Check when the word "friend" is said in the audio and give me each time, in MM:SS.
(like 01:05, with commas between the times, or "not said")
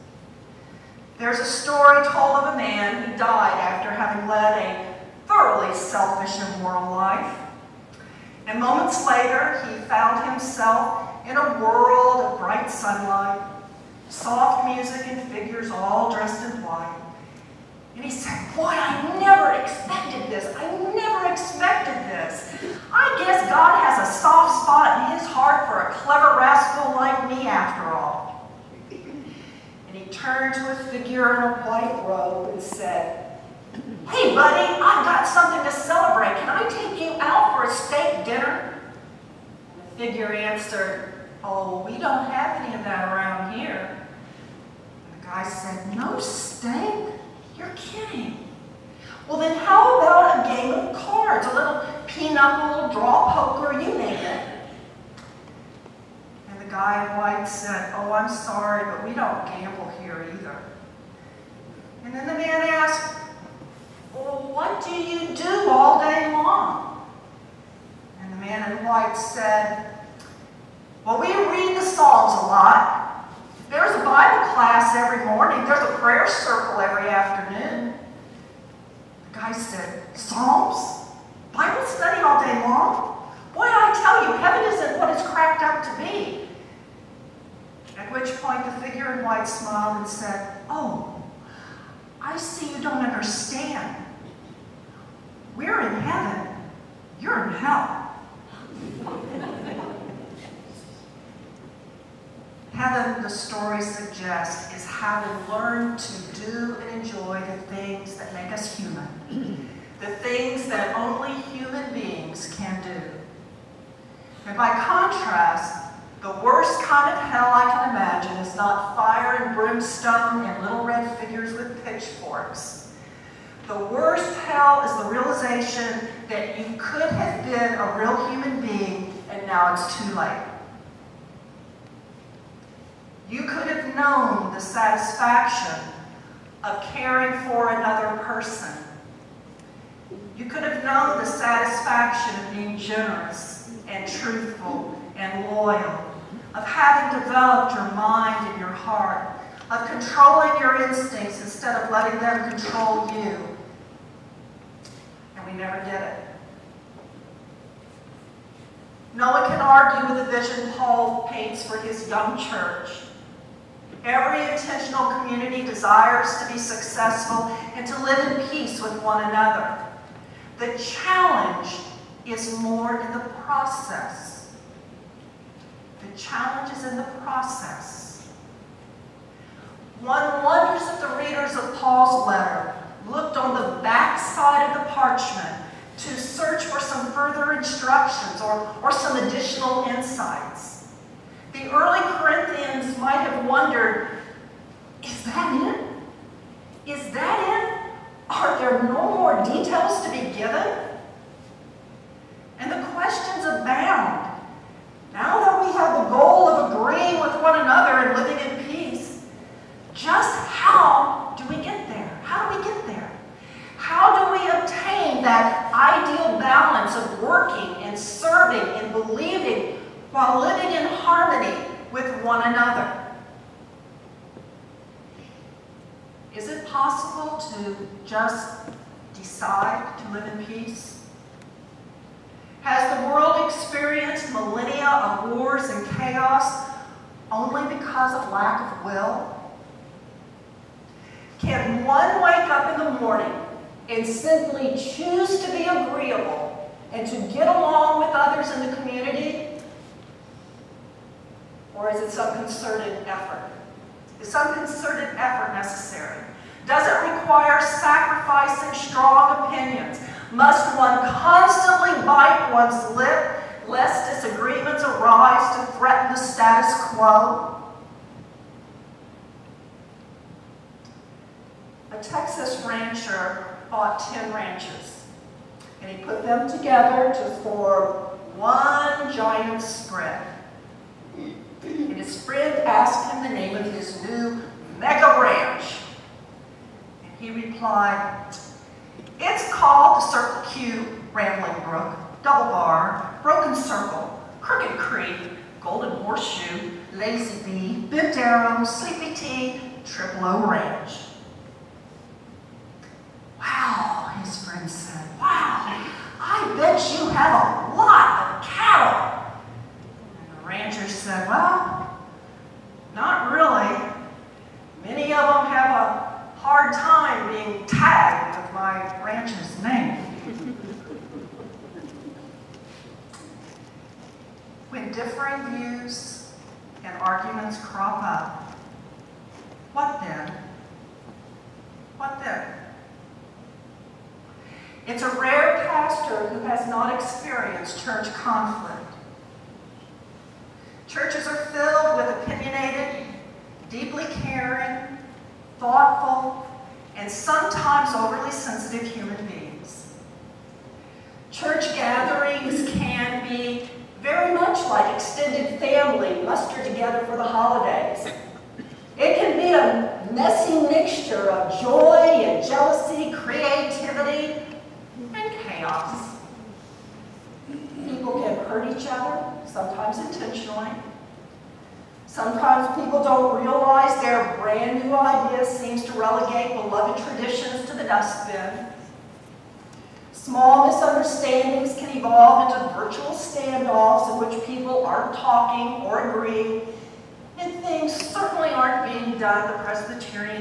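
04:42, 05:04.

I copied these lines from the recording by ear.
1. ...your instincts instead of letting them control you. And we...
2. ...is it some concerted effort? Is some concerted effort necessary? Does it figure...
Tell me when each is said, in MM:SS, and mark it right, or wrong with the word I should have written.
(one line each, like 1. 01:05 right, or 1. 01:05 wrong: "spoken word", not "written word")
1. 02:30 right
2. 04:11 wrong: "require", not "figure".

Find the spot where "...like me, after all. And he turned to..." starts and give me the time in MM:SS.
00:26.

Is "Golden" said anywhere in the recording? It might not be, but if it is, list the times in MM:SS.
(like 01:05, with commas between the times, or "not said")
04:55.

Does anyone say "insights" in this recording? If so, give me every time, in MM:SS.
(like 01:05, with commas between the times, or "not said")
03:09.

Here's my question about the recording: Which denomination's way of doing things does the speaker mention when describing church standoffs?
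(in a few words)
Presbyterian.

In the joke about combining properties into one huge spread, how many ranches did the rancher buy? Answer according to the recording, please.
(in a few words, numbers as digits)
10.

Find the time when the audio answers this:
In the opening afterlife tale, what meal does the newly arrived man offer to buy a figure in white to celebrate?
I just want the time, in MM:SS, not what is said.
00:37.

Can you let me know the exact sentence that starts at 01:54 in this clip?
And by contrast, the worst kind of hell I can imagine is not fire and brimstone and little red figures with pitchforks.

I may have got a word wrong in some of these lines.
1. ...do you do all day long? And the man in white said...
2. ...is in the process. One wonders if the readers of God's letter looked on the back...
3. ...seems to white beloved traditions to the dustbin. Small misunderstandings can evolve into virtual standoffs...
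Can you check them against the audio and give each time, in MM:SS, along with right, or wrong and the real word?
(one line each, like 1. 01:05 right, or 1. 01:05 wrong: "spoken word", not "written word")
1. 01:04 right
2. 02:56 wrong: "Paul", not "God"
3. 06:15 wrong: "relegate", not "white".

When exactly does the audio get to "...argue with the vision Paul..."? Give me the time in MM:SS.
02:39.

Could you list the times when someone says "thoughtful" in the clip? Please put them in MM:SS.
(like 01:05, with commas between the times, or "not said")
05:45.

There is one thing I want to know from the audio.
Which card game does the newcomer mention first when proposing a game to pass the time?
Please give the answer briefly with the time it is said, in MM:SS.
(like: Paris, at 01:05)
pinochle, at 00:52.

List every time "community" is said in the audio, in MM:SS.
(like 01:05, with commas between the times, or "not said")
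02:45, 04:08.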